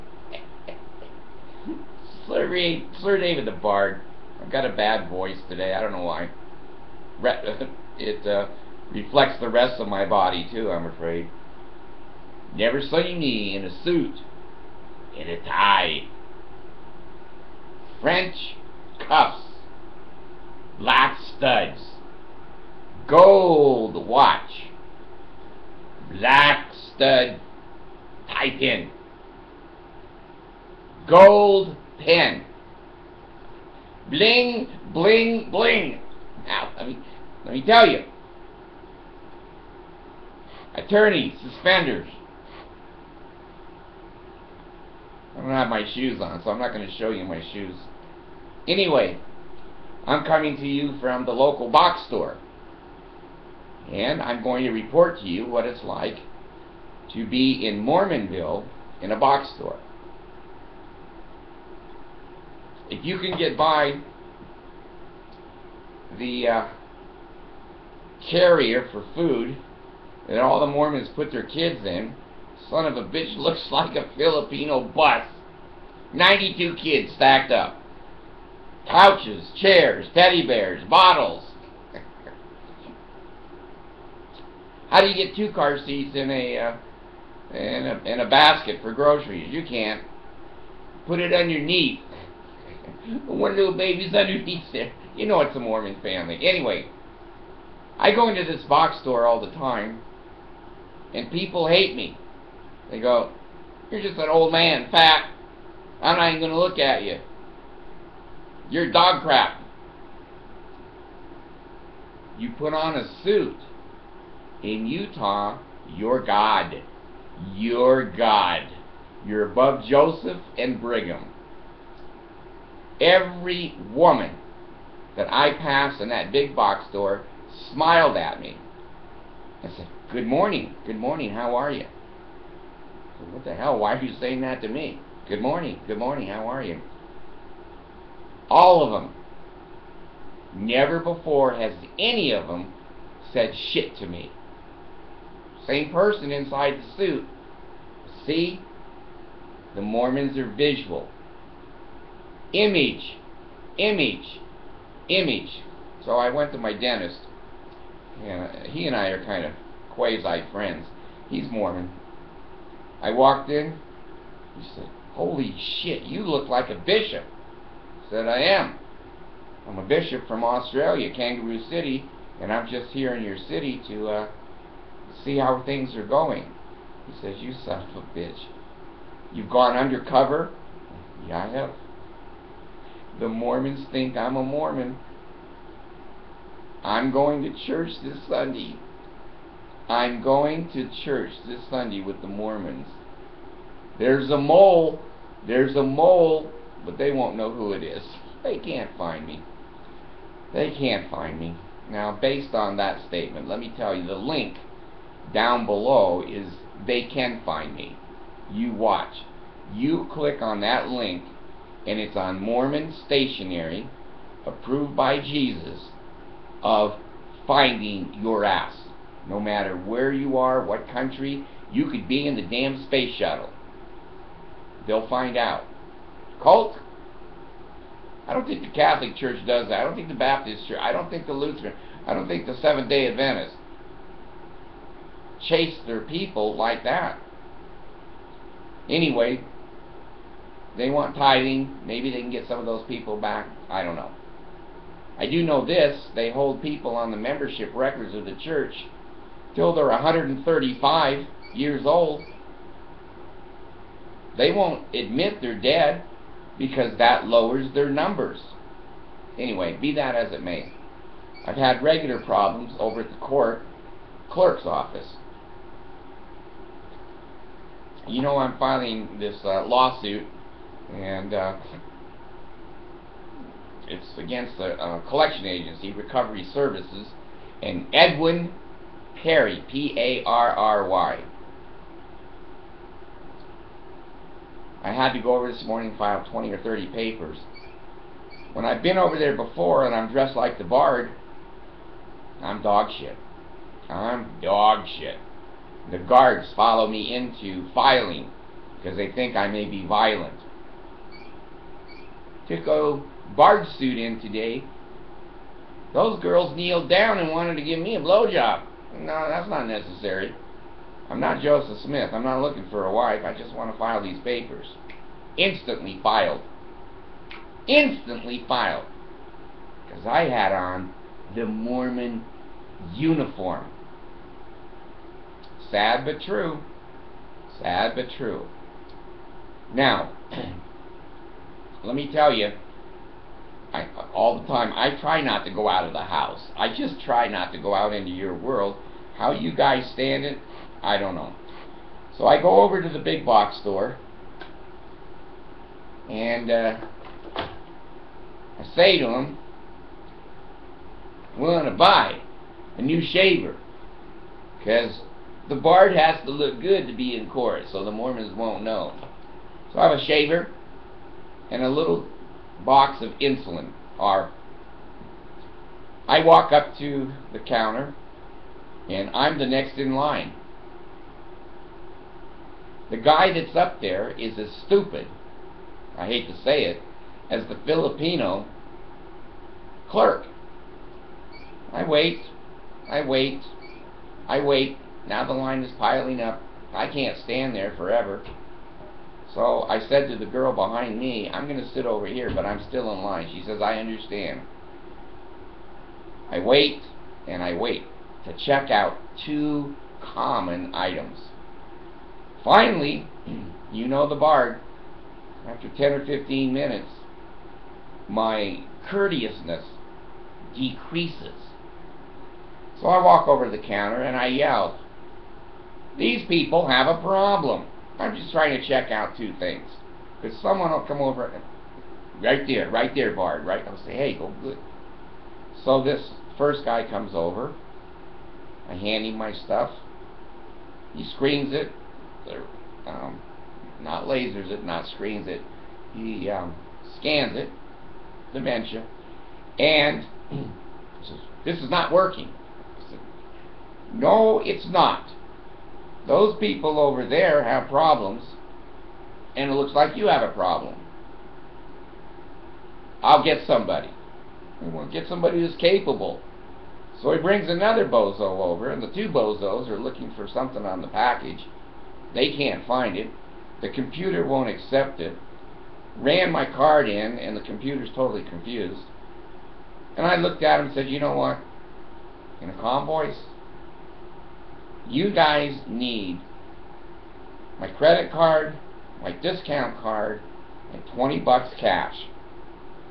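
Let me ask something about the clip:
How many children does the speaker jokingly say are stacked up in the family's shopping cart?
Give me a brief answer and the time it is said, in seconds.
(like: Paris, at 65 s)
92, at 76 s.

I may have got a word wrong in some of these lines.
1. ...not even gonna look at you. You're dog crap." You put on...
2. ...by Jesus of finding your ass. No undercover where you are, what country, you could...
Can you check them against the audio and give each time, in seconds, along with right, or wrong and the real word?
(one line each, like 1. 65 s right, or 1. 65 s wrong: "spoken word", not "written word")
1. 106 s right
2. 214 s wrong: "matter", not "undercover".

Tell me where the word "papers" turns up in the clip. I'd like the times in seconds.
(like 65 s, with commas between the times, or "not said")
286 s, 314 s.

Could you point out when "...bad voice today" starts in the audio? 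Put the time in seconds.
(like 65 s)
4 s.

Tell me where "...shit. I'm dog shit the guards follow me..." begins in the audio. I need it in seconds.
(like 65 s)
292 s.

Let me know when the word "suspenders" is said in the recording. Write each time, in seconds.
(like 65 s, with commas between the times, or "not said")
41 s.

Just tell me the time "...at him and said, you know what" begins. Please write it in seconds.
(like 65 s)
470 s.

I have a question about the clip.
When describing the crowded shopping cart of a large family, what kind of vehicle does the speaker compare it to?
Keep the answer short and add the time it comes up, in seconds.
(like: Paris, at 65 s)
Filipino bus, at 74 s.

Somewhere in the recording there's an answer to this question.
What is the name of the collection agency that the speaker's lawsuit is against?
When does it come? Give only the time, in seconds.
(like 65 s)
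275 s.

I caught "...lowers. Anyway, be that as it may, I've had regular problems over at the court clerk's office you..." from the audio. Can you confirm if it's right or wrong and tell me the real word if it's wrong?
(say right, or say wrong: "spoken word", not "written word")
wrong: "numbers", not "lowers".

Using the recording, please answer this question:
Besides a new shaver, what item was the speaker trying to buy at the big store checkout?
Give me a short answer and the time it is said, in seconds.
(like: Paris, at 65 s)
insulin, at 363 s.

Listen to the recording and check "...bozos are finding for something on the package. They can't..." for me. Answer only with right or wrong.
wrong.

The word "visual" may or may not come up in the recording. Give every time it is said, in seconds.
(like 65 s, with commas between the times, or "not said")
150 s.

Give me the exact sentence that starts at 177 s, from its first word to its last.
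He says, You son of a bitch.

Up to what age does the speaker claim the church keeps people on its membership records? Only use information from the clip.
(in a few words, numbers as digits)
135.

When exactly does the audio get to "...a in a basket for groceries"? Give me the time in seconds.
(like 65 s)
87 s.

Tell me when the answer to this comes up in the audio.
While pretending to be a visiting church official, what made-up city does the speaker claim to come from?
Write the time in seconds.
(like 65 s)
171 s.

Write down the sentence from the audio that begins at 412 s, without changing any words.
So I walk over to the counter and I yell, these people have a problem.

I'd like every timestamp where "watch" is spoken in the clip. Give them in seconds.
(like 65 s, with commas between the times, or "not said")
24 s, 208 s.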